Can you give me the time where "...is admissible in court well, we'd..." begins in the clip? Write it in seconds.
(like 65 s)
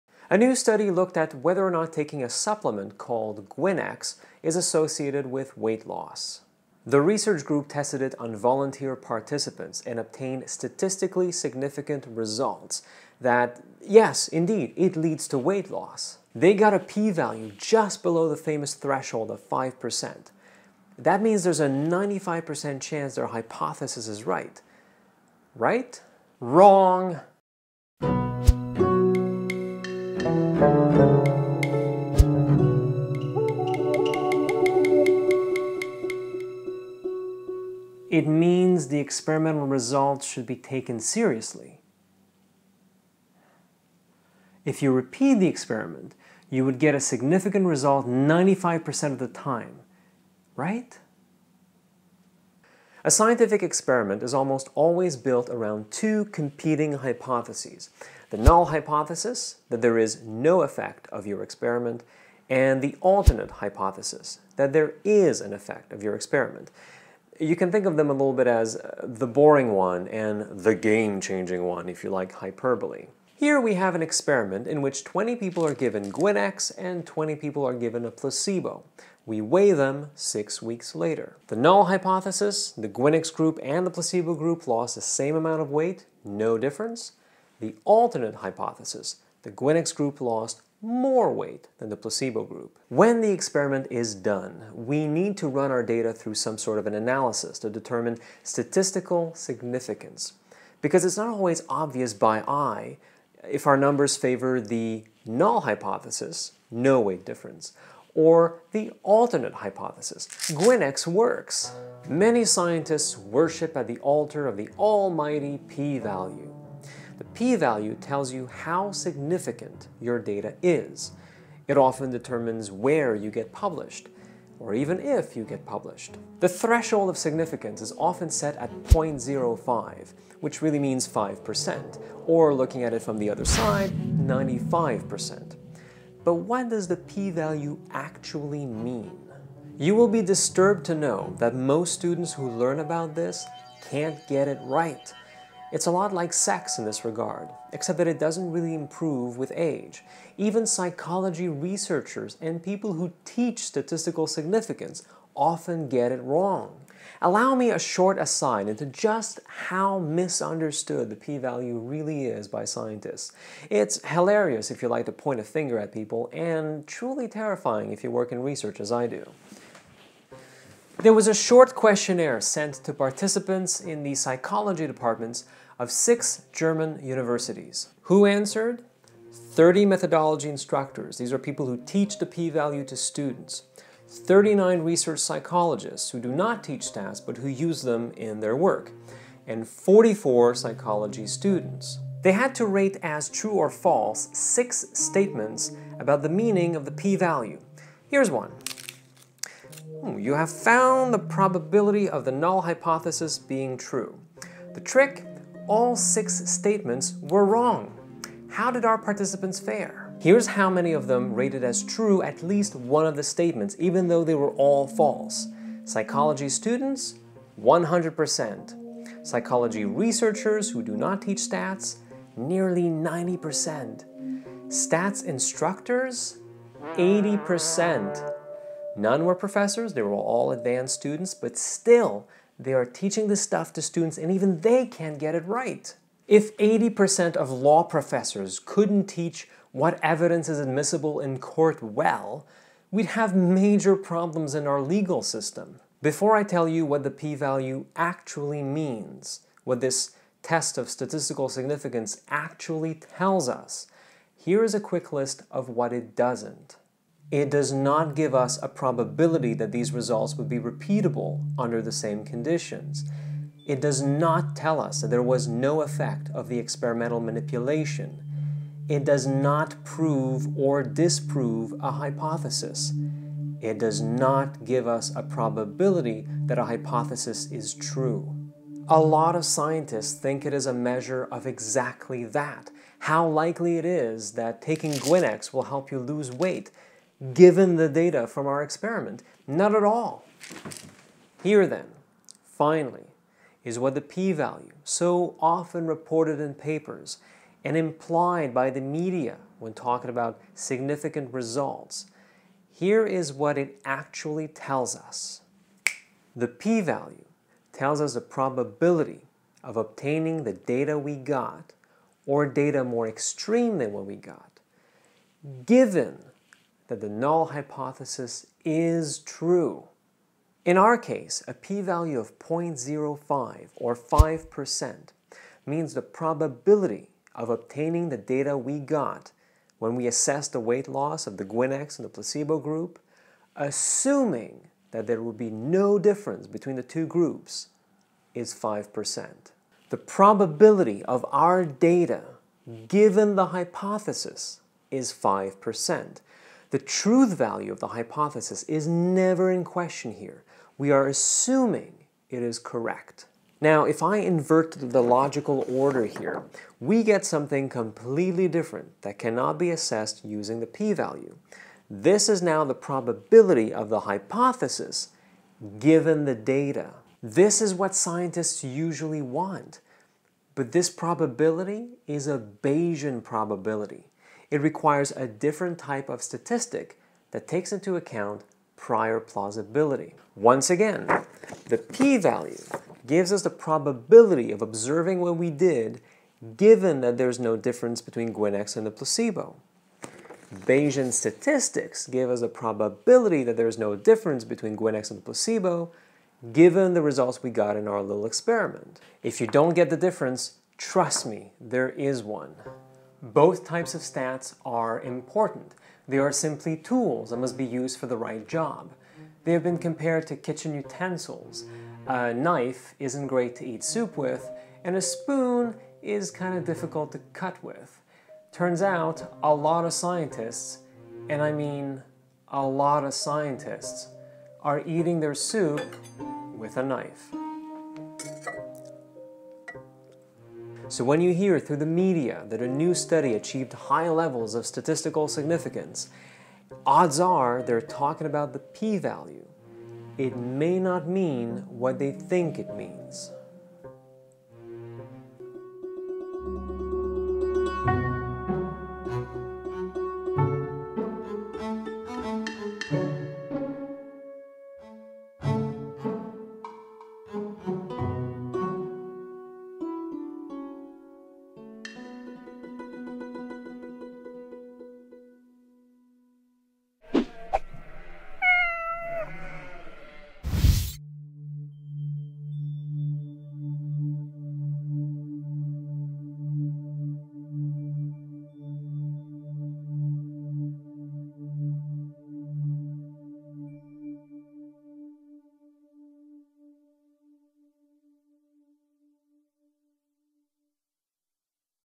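240 s.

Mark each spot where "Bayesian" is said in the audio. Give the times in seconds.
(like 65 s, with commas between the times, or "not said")
372 s, 390 s.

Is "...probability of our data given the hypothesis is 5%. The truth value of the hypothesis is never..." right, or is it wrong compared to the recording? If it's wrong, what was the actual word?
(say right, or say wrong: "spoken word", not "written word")
right.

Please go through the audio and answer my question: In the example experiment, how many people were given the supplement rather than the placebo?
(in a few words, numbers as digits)
20.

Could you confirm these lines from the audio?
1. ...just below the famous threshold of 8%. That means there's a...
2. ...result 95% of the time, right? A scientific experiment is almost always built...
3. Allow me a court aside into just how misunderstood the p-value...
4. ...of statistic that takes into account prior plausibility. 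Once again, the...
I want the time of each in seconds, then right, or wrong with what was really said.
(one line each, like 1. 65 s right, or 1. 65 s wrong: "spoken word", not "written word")
1. 17 s wrong: "5", not "8"
2. 47 s right
3. 157 s wrong: "short", not "court"
4. 376 s right.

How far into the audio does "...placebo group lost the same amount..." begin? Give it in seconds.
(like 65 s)
83 s.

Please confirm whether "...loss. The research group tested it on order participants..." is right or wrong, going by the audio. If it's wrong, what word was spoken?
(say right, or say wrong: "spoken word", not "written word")
wrong: "volunteer", not "order".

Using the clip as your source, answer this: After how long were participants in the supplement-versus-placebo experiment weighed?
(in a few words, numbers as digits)
Six weeks.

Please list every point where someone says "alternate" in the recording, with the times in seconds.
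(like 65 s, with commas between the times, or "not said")
63 s, 87 s, 109 s.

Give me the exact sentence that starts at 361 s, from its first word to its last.
This is now the probability of the hypothesis given the data.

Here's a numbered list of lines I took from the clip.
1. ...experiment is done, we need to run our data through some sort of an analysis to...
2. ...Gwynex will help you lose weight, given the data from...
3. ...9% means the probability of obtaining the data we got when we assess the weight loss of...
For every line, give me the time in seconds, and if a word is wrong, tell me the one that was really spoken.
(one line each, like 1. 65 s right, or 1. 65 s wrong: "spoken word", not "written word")
1. 93 s right
2. 284 s right
3. 323 s wrong: "5", not "9".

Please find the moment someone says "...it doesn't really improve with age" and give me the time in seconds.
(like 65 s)
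148 s.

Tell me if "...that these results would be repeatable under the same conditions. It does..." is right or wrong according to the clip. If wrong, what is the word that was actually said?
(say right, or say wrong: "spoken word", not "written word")
right.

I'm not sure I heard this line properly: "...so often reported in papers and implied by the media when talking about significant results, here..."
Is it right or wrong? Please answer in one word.
right.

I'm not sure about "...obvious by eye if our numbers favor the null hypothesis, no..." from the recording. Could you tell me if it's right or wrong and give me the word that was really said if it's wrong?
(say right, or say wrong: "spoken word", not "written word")
right.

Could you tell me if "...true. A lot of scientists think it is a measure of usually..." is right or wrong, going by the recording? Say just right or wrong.
wrong.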